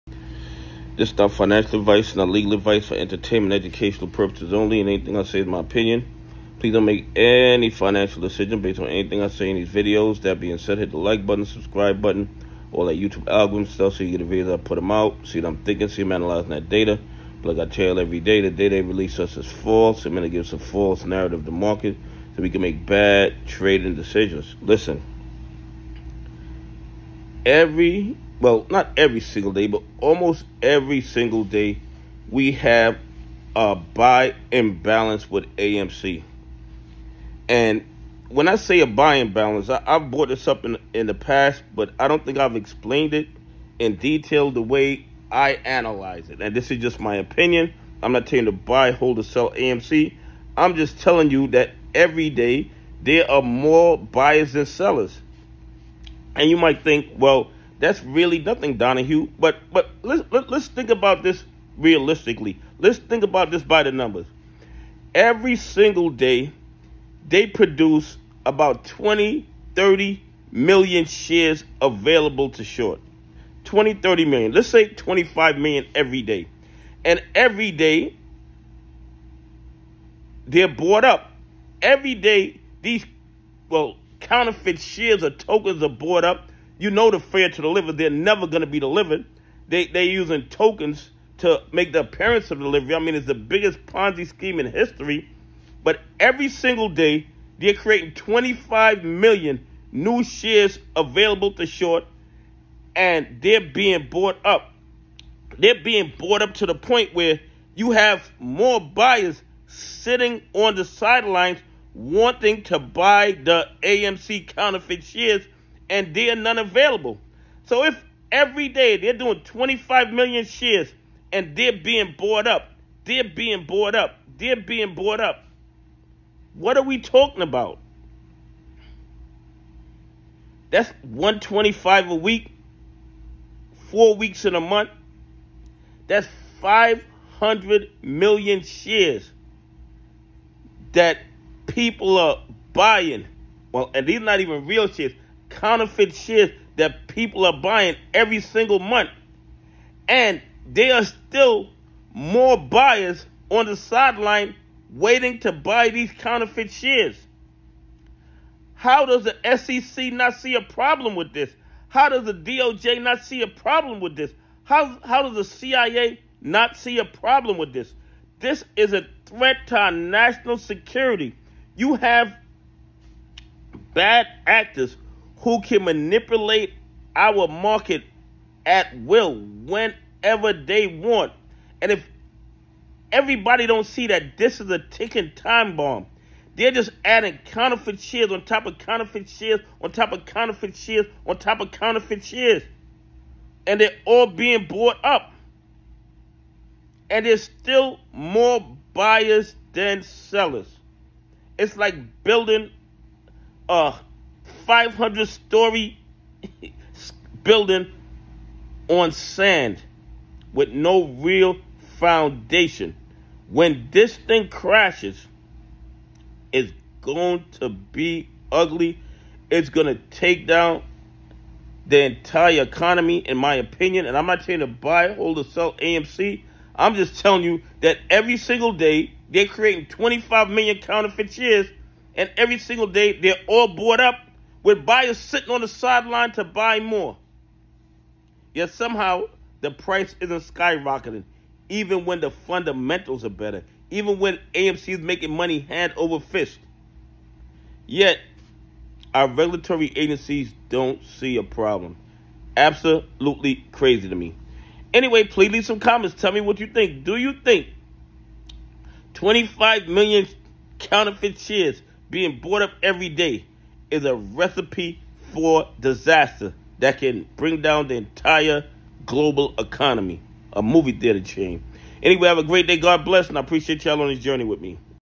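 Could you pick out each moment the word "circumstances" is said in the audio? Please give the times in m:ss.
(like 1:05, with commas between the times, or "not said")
not said.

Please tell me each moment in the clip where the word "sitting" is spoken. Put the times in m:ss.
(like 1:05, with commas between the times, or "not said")
1:49, 3:55.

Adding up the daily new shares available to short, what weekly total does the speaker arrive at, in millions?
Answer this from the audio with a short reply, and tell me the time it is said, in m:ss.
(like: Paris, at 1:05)
125 million, at 2:11.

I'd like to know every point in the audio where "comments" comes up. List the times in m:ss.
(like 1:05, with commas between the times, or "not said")
4:15.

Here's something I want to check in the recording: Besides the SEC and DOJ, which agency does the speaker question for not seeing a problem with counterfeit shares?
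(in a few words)
CIA.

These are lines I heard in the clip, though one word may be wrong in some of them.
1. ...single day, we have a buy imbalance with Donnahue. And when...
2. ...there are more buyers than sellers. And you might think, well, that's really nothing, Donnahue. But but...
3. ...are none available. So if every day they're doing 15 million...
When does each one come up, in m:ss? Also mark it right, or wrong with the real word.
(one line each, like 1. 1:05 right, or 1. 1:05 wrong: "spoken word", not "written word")
1. 0:31 wrong: "AMC", not "Donnahue"
2. 0:53 right
3. 1:56 wrong: "25", not "15".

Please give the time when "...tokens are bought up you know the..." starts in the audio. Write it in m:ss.
1:25.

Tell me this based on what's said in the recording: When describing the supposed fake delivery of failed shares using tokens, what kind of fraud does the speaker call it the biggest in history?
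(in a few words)
Ponzi scheme.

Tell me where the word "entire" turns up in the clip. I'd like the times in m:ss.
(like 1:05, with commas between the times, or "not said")
3:42, 4:27.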